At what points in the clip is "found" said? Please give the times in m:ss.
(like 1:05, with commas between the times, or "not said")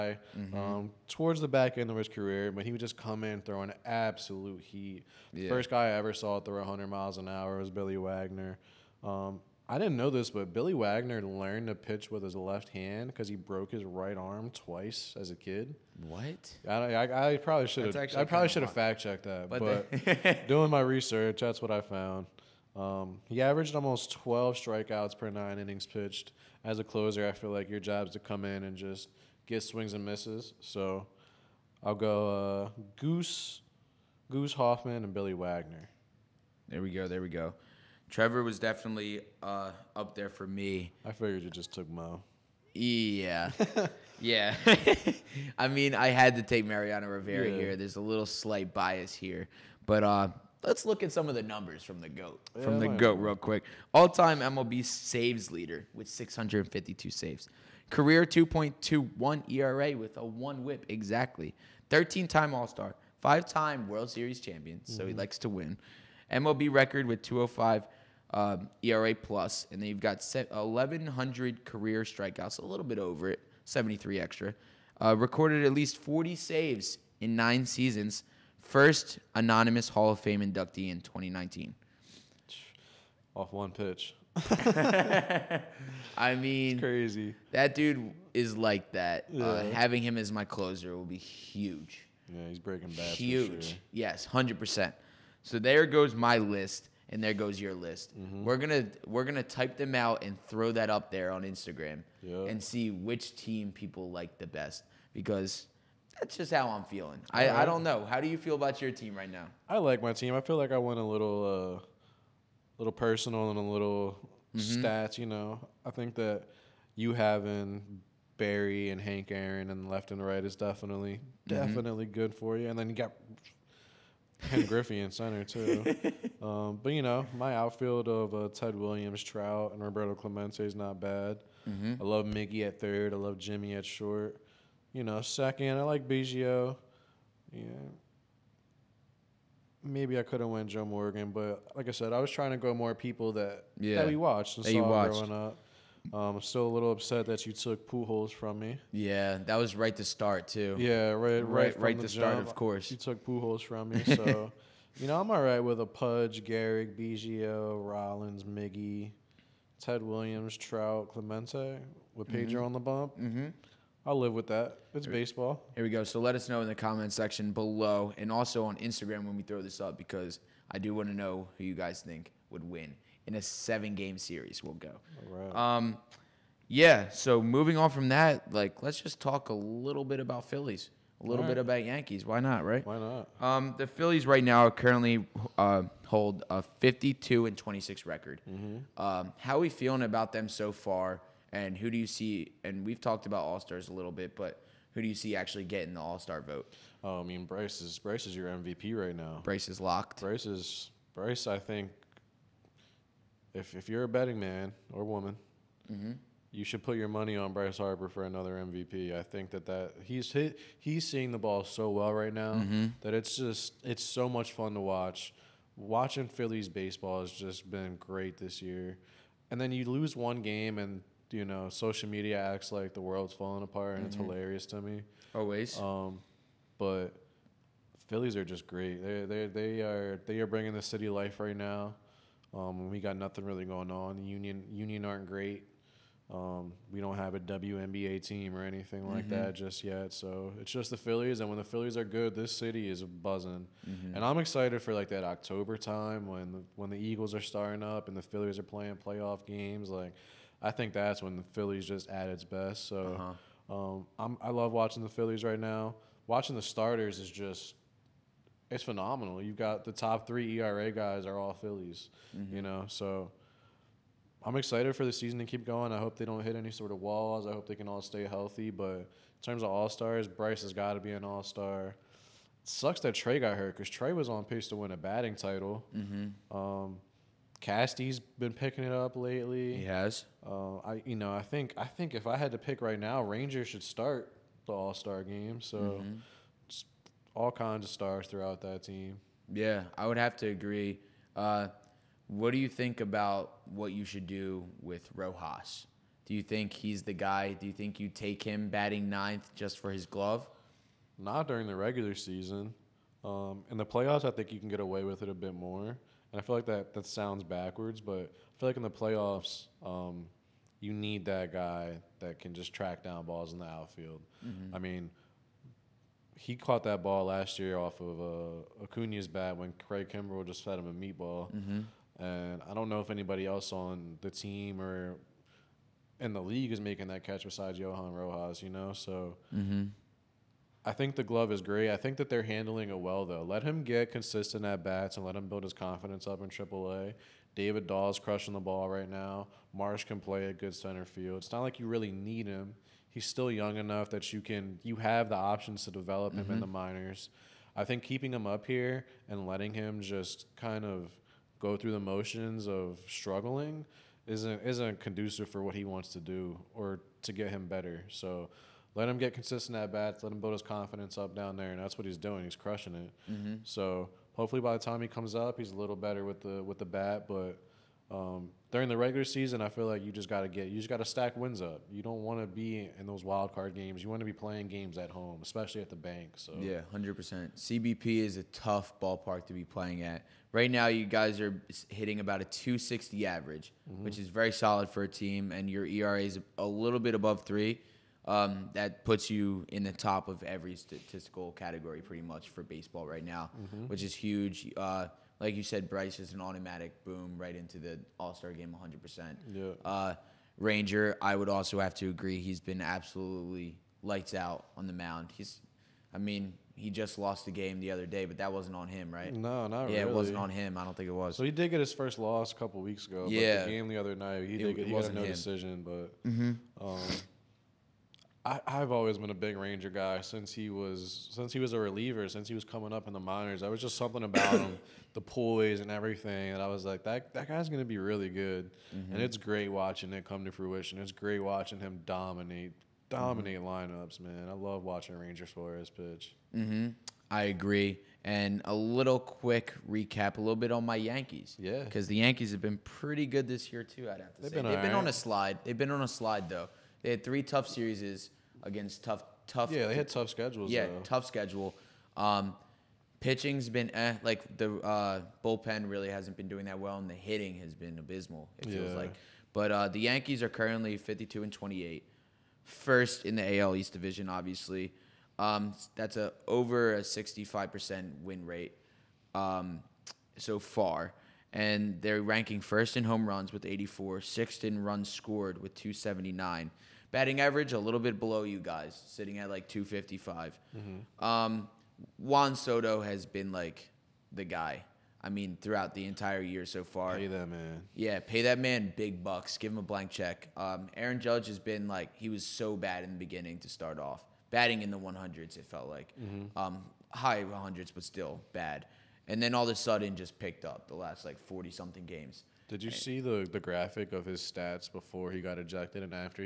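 0:21.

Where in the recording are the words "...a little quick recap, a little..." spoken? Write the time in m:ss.
7:18.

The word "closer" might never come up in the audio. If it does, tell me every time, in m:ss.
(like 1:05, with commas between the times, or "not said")
0:26, 1:30.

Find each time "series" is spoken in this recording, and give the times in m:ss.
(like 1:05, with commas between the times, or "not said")
1:04, 2:54, 7:27.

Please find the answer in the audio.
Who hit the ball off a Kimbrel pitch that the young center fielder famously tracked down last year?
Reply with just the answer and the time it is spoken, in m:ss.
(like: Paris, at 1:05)
Acuna, at 5:18.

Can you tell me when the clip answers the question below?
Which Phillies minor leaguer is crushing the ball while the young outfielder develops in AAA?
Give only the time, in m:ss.
5:37.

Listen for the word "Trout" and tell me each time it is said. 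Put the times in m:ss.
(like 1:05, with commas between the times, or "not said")
2:09, 2:40.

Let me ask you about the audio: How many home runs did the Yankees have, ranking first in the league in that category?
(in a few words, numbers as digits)
84.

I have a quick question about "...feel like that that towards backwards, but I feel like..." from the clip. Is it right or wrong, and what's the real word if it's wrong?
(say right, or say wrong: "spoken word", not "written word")
wrong: "sounds", not "towards".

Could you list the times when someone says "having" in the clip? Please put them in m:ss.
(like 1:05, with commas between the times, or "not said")
1:29, 1:57.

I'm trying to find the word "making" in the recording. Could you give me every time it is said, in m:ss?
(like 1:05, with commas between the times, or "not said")
5:26.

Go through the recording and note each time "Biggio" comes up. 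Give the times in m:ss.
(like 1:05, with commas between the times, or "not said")
2:16, 2:36.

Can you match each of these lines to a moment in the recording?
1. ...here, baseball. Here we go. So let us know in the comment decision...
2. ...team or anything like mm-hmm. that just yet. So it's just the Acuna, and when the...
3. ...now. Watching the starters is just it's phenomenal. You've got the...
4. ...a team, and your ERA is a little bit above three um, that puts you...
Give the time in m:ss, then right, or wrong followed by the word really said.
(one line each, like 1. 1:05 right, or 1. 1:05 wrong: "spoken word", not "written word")
1. 2:45 wrong: "section", not "decision"
2. 3:58 wrong: "Phillies", not "Acuna"
3. 4:15 right
4. 6:25 right.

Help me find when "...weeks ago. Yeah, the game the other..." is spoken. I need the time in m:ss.
6:52.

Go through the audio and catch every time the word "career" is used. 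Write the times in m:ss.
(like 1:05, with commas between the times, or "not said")
0:02, 0:57, 1:11.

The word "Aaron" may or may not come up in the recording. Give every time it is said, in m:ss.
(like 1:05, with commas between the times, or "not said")
1:59, 8:10.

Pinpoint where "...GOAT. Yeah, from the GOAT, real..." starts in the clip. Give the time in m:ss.
0:52.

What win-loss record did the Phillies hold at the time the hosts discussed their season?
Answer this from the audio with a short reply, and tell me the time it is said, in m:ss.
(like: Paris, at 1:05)
52 and 26, at 3:06.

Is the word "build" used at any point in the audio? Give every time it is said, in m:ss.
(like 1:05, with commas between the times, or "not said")
5:35, 6:00.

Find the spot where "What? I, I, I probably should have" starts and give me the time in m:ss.
0:16.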